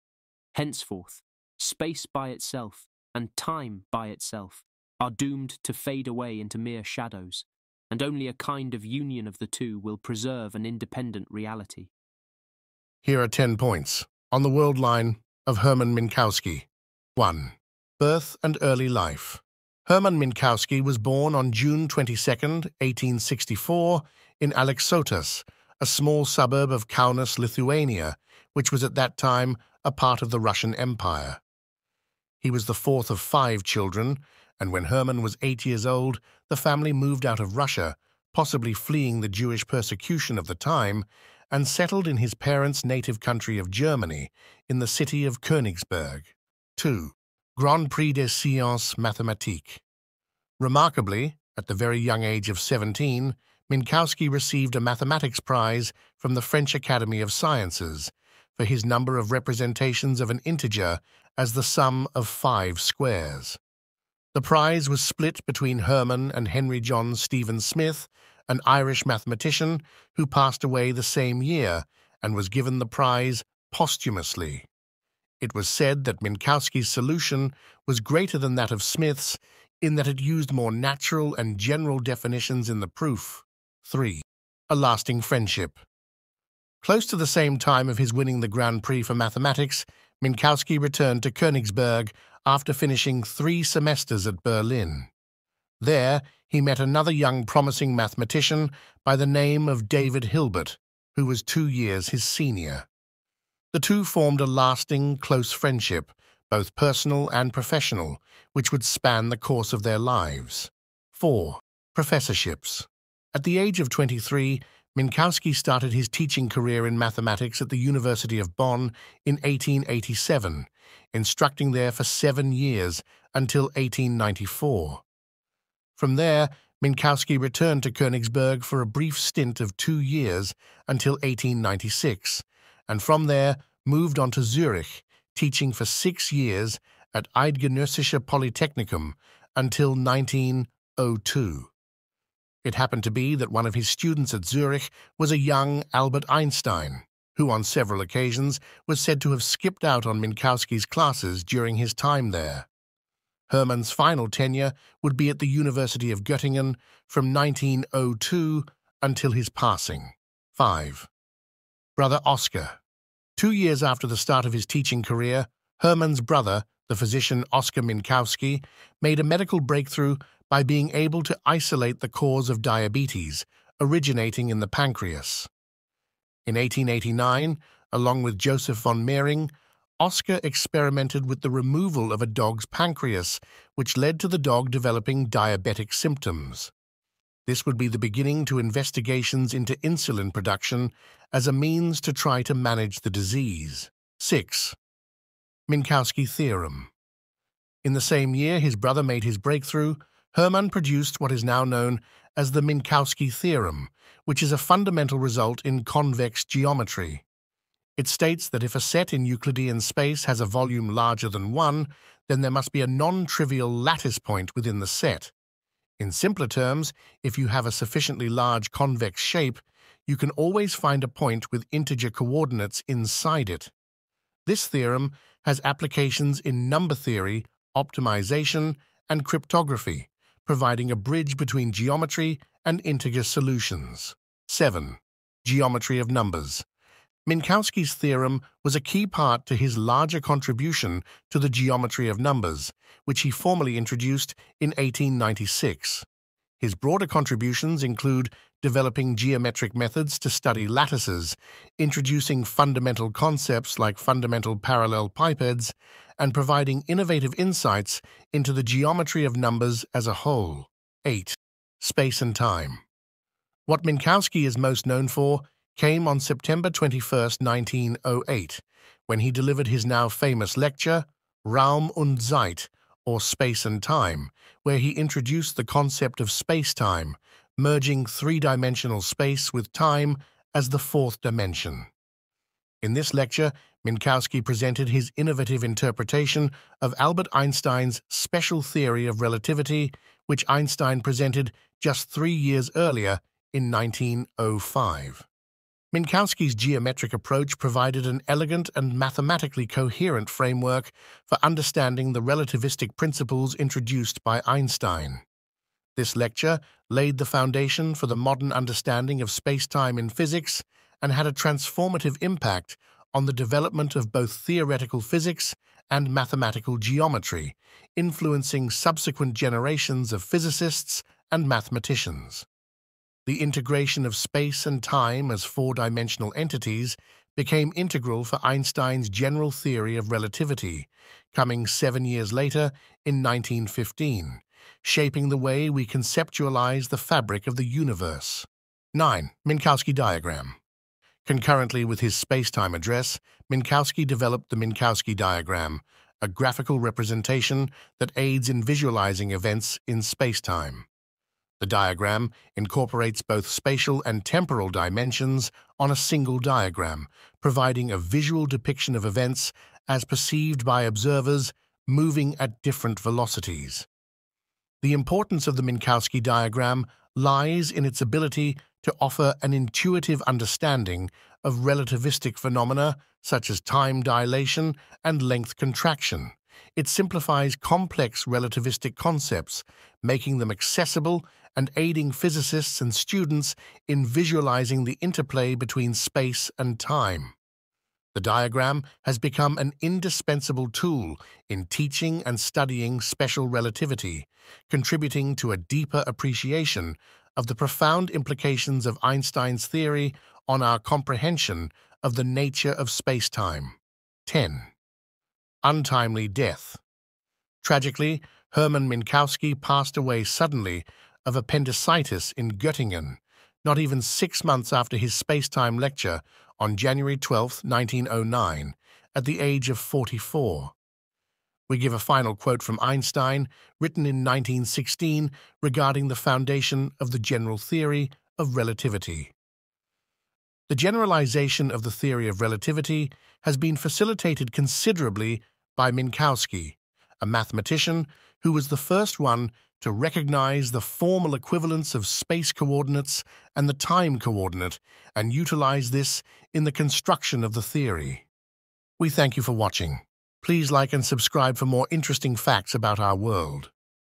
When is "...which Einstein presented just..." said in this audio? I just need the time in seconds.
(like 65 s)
290 s.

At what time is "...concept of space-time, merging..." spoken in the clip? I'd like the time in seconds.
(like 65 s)
275 s.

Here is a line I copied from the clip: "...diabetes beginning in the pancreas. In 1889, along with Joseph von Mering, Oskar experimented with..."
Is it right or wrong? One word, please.
wrong.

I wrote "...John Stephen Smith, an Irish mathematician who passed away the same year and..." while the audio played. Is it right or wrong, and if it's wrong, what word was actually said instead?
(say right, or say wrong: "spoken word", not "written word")
right.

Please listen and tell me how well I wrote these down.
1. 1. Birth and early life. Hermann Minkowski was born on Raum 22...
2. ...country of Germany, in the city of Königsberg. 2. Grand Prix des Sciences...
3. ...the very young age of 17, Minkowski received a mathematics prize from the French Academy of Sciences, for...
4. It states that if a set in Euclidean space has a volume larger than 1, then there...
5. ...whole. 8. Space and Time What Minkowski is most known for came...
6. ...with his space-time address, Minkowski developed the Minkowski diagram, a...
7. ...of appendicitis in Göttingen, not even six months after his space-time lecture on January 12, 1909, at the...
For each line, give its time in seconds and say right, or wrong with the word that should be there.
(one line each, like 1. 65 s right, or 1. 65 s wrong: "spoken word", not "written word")
1. 17 s wrong: "June", not "Raum"
2. 43 s right
3. 51 s right
4. 207 s right
5. 260 s right
6. 341 s right
7. 411 s right.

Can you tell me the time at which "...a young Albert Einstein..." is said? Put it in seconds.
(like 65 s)
145 s.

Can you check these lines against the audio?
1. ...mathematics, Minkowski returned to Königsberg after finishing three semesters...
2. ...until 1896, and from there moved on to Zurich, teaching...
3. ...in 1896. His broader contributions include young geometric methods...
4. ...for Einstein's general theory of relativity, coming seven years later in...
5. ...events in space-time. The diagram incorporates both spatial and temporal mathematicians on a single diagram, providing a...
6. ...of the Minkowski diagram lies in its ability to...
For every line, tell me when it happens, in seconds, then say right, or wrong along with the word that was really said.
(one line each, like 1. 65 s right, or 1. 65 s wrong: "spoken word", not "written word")
1. 89 s right
2. 130 s right
3. 244 s wrong: "developing", not "young"
4. 328 s right
5. 349 s wrong: "dimensions", not "mathematicians"
6. 365 s right.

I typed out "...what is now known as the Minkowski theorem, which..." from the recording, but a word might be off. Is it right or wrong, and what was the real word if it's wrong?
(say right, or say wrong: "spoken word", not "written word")
right.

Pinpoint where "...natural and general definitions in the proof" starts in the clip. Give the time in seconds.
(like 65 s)
80 s.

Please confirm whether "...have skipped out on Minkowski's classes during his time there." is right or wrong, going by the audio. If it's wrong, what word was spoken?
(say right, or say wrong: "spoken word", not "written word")
right.